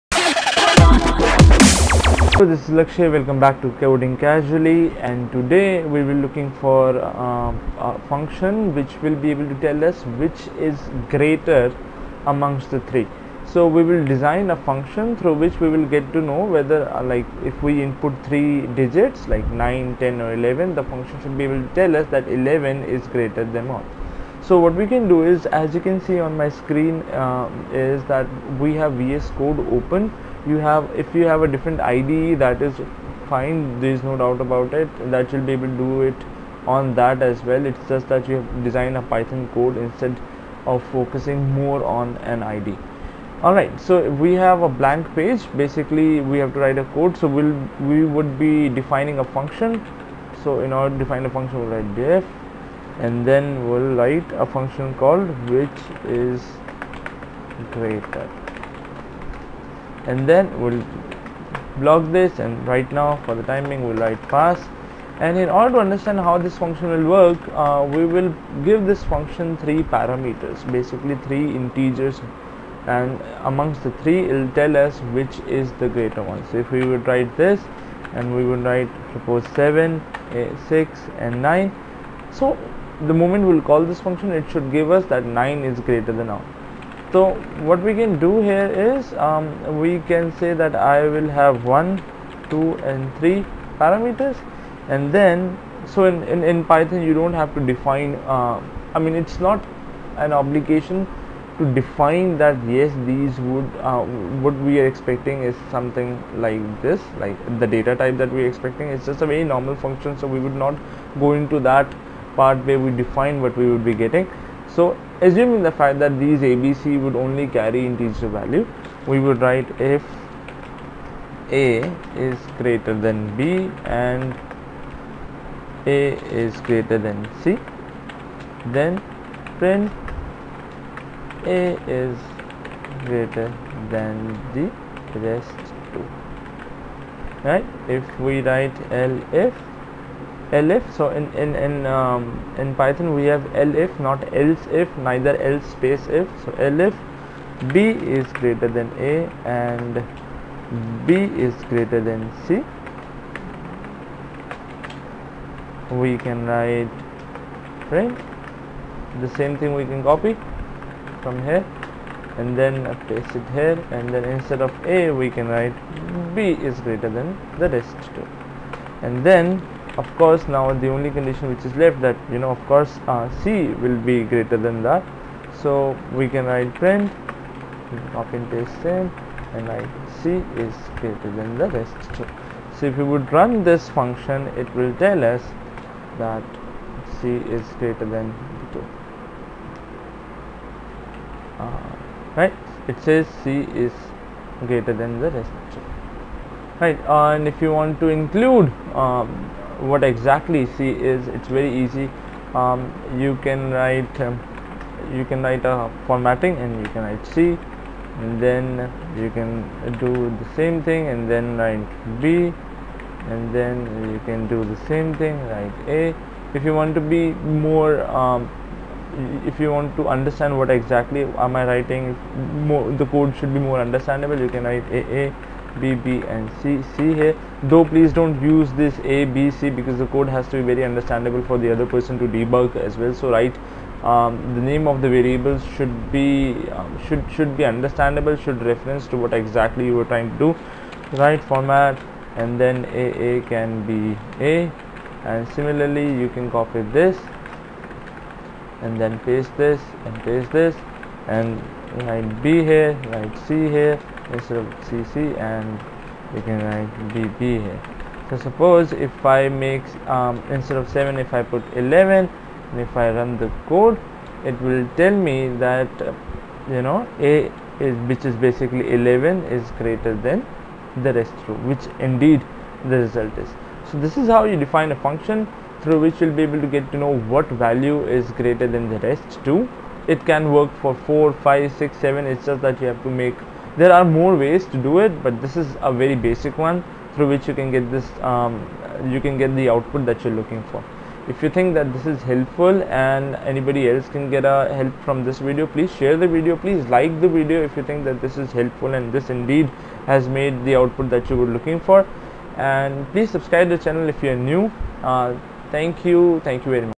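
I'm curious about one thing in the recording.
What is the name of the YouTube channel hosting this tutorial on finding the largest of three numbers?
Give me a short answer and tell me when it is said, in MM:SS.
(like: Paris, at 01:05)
Coding Casually, at 00:03.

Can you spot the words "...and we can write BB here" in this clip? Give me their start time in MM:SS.
04:15.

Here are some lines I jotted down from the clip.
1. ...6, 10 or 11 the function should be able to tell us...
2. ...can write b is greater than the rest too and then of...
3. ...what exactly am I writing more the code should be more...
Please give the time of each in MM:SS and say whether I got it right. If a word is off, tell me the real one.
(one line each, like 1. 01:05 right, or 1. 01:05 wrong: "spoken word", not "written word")
1. 00:19 wrong: "9", not "6"
2. 02:45 right
3. 03:40 right.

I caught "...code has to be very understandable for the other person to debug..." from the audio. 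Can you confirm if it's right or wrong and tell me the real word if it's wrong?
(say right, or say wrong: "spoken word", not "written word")
right.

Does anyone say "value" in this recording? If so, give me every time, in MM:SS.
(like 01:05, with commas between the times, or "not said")
01:58, 04:37.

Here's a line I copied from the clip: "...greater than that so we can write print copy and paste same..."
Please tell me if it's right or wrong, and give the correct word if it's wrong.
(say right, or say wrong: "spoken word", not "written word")
right.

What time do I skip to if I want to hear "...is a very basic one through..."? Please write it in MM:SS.
04:45.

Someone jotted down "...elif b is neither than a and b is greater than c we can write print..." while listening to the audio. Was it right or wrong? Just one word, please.
wrong.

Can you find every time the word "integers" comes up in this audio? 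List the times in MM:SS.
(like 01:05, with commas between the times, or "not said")
01:11, 01:57.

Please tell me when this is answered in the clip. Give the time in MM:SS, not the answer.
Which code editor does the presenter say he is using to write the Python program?
00:28.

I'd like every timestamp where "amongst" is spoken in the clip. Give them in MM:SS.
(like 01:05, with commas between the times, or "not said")
00:12, 01:13.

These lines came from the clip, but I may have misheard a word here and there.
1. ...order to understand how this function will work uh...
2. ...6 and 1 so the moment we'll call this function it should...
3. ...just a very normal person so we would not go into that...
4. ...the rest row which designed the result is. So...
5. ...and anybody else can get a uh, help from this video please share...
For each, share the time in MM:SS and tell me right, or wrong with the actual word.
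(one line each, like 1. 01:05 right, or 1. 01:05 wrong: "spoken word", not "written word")
1. 01:05 right
2. 01:20 wrong: "9", not "1"
3. 01:49 wrong: "function", not "person"
4. 04:31 wrong: "indeed", not "designed"
5. 04:52 right.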